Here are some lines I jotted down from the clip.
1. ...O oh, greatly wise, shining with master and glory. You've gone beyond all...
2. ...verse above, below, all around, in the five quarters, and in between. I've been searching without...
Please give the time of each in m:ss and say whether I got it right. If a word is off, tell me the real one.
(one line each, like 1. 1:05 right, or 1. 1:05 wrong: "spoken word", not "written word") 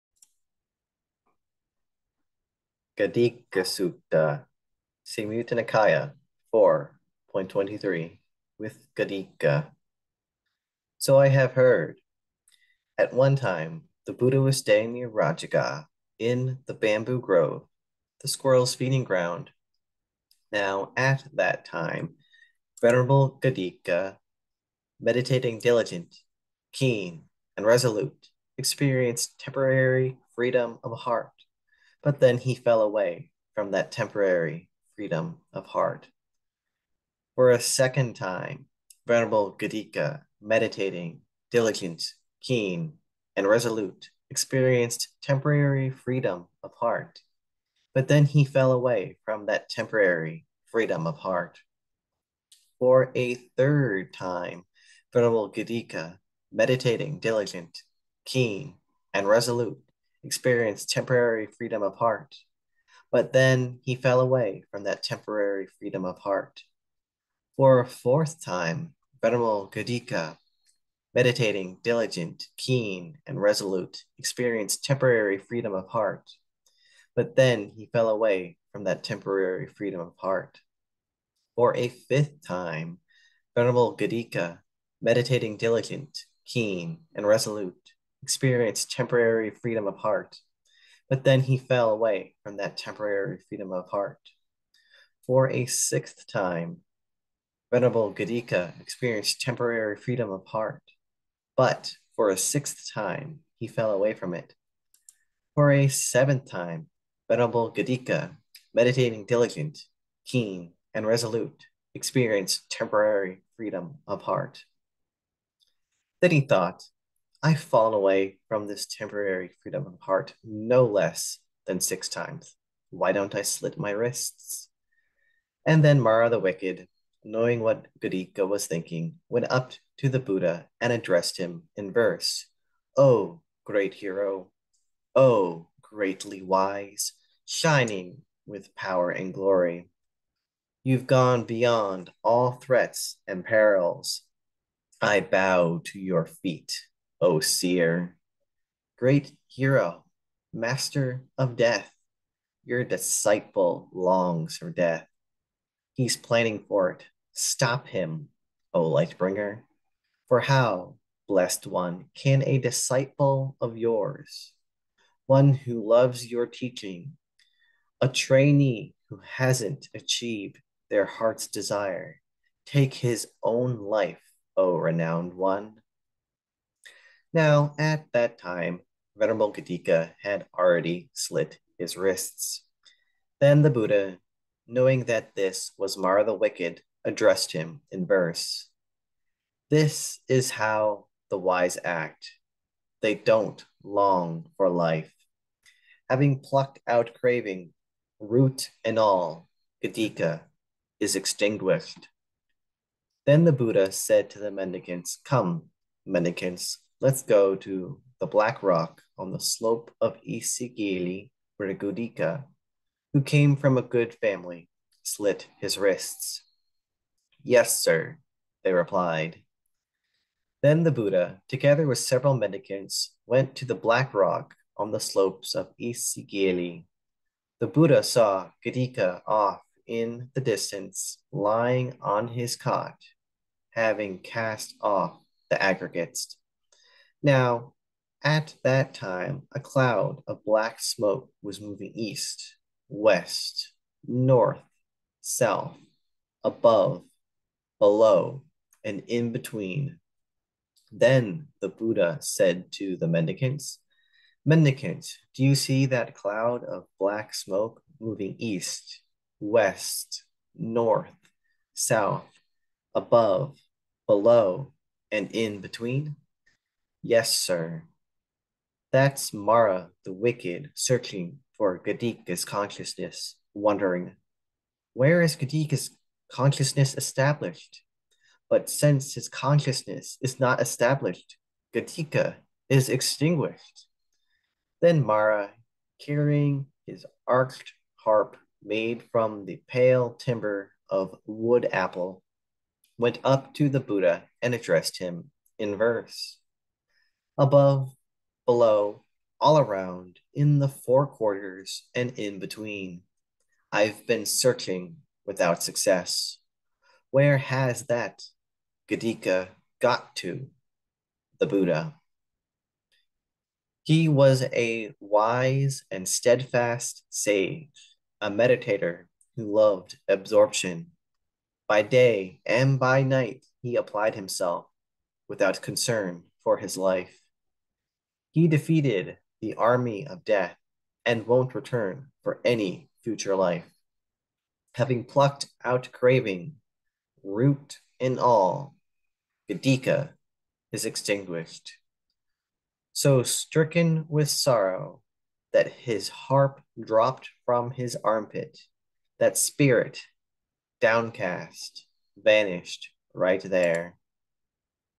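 1. 2:15 wrong: "power", not "master"
2. 4:55 wrong: "four", not "five".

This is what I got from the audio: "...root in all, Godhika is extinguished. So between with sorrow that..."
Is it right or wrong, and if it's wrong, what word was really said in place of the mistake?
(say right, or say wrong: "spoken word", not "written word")
wrong: "stricken", not "between".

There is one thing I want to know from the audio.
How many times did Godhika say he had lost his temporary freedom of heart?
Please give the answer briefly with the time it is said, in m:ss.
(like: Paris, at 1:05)
6, at 2:01.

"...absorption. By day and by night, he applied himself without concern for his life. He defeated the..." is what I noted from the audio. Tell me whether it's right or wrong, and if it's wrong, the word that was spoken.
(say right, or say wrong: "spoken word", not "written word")
right.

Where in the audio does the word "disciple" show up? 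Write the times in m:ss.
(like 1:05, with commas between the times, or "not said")
2:32, 2:42.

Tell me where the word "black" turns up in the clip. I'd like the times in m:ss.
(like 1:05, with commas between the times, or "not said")
3:28, 3:43, 4:00, 4:16.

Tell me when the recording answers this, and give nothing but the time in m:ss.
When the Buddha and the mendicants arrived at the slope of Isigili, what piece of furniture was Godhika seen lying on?
3:52.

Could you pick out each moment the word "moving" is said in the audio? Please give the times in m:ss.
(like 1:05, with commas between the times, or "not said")
4:01, 4:17.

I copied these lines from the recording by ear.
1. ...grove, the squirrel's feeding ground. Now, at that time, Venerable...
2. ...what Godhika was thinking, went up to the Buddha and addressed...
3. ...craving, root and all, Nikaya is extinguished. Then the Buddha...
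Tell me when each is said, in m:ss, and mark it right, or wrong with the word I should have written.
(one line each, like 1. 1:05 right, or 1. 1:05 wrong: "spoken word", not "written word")
1. 0:17 right
2. 2:07 right
3. 3:17 wrong: "Godhika", not "Nikaya".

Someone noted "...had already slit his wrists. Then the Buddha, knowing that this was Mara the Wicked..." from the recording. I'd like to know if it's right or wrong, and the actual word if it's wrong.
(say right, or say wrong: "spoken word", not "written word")
right.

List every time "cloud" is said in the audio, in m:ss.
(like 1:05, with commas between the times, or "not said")
3:59, 4:16.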